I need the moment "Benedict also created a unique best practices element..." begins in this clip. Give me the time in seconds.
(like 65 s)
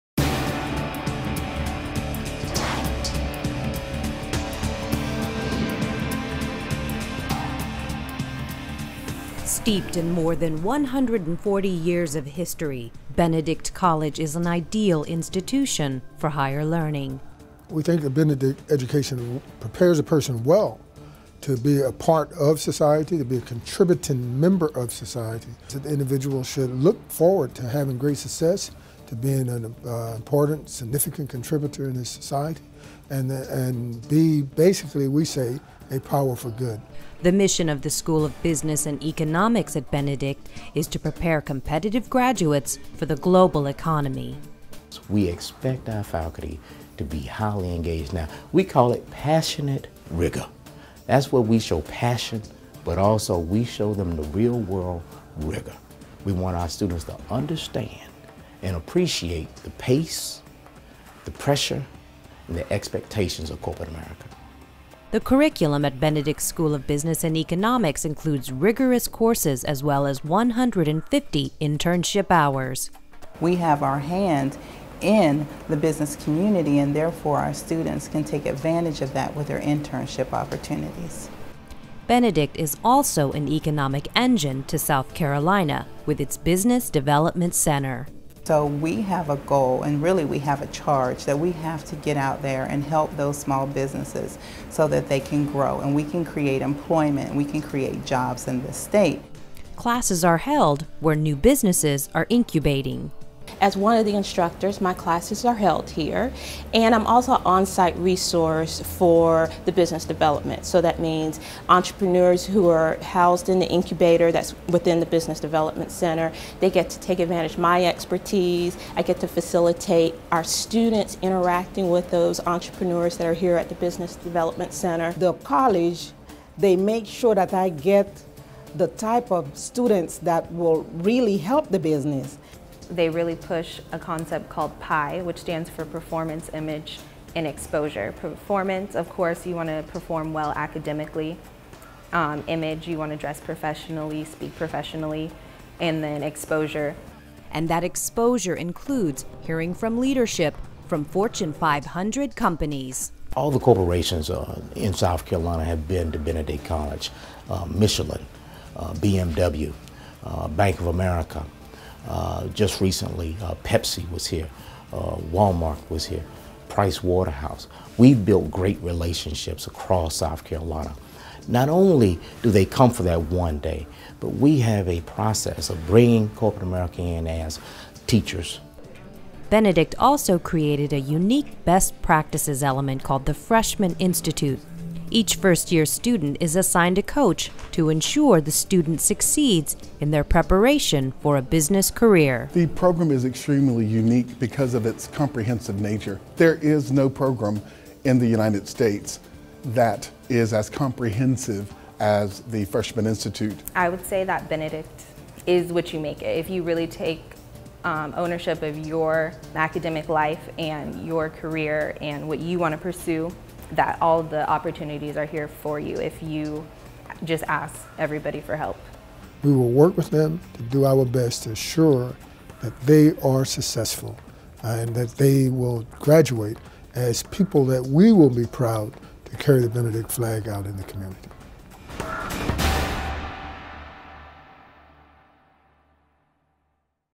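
179 s.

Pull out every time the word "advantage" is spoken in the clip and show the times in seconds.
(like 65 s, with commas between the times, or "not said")
78 s, 117 s.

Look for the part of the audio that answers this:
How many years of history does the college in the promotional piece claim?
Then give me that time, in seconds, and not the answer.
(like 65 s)
10 s.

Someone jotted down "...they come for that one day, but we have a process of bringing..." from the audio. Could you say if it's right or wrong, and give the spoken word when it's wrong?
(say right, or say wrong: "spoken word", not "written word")
right.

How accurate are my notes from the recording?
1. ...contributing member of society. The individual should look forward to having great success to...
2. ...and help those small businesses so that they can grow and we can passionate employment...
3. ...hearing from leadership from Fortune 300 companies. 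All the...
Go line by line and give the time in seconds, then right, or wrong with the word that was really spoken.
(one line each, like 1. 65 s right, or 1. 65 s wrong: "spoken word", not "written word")
1. 23 s right
2. 92 s wrong: "create", not "passionate"
3. 149 s wrong: "500", not "300".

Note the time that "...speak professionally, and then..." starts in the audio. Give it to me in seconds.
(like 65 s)
144 s.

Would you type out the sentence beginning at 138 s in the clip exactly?
Performance, of course, you want to perform well academically.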